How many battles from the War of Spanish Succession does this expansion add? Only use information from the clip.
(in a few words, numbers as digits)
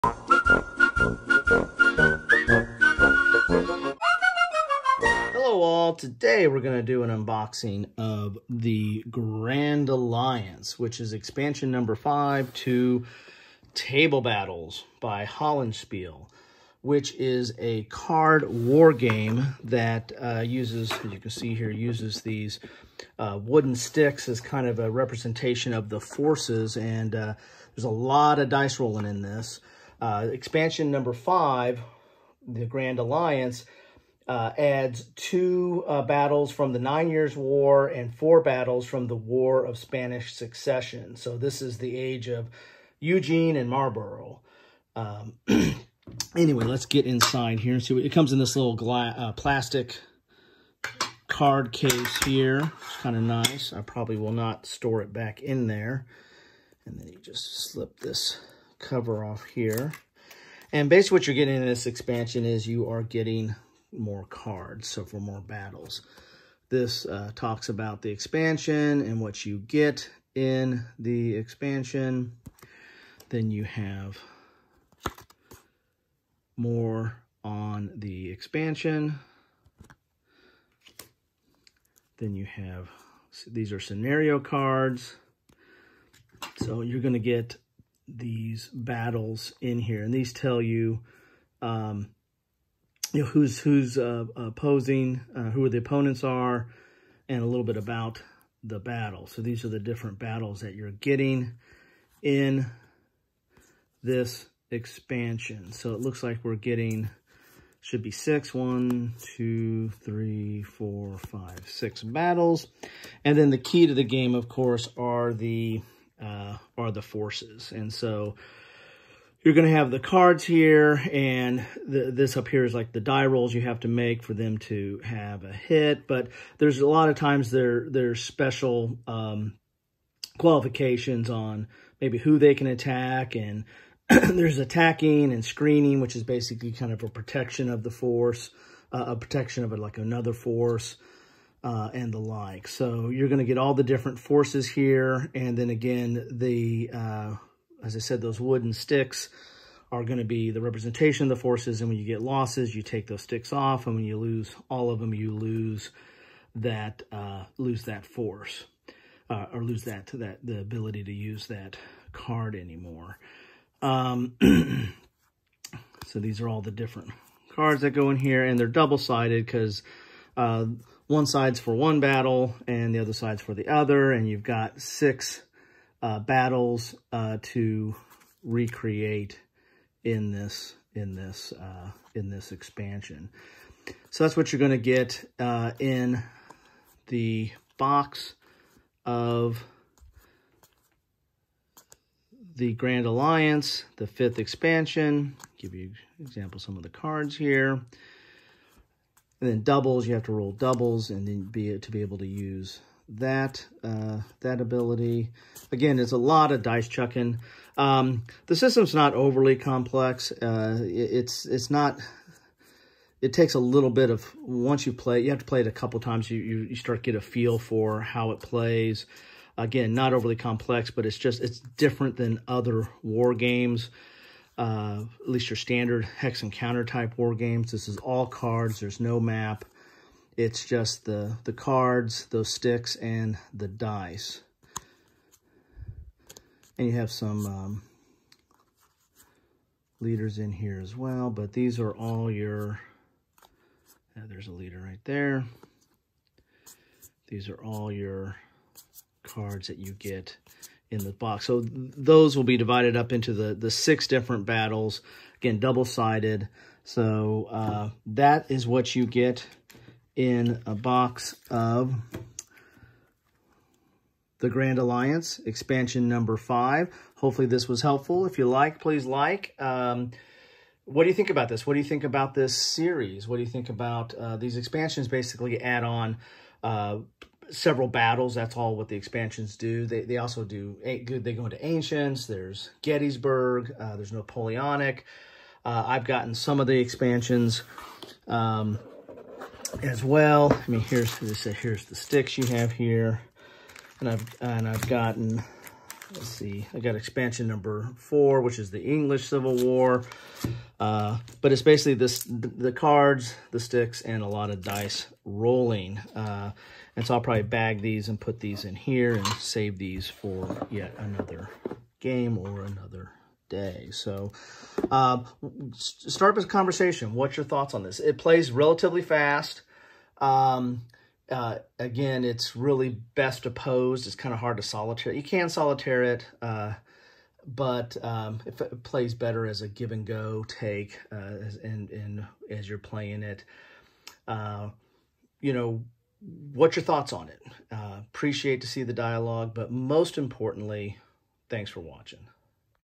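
4.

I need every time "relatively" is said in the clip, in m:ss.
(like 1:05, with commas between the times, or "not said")
5:18.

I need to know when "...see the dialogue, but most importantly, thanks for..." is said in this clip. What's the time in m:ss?
5:38.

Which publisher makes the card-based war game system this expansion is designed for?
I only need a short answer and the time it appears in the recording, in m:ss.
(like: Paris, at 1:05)
Hollandspiele, at 0:15.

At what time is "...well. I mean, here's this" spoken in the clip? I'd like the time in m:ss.
4:50.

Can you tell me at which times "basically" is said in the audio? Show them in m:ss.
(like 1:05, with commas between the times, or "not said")
1:00, 2:16, 4:35, 5:01.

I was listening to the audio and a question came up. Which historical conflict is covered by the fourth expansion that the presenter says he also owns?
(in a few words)
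English Civil War.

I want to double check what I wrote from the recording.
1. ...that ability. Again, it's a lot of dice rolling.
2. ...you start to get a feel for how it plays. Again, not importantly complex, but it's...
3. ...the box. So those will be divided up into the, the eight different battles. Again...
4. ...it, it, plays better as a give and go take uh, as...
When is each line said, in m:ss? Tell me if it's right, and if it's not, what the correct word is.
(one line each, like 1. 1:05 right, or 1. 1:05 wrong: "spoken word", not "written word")
1. 3:24 wrong: "chucking", not "rolling"
2. 3:36 wrong: "overly", not "importantly"
3. 4:11 wrong: "six", not "eight"
4. 5:28 right.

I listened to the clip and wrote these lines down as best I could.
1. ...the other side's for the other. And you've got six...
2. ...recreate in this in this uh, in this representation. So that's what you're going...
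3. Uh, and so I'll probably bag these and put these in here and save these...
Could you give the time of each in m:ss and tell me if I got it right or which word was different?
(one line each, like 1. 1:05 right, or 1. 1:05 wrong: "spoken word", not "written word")
1. 2:52 right
2. 2:58 wrong: "expansion", not "representation"
3. 5:06 right.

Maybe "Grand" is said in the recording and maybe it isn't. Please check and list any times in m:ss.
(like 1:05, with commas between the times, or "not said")
0:09, 0:32, 3:12, 4:24.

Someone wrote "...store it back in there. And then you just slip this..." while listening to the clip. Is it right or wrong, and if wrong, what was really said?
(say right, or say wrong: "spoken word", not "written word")
right.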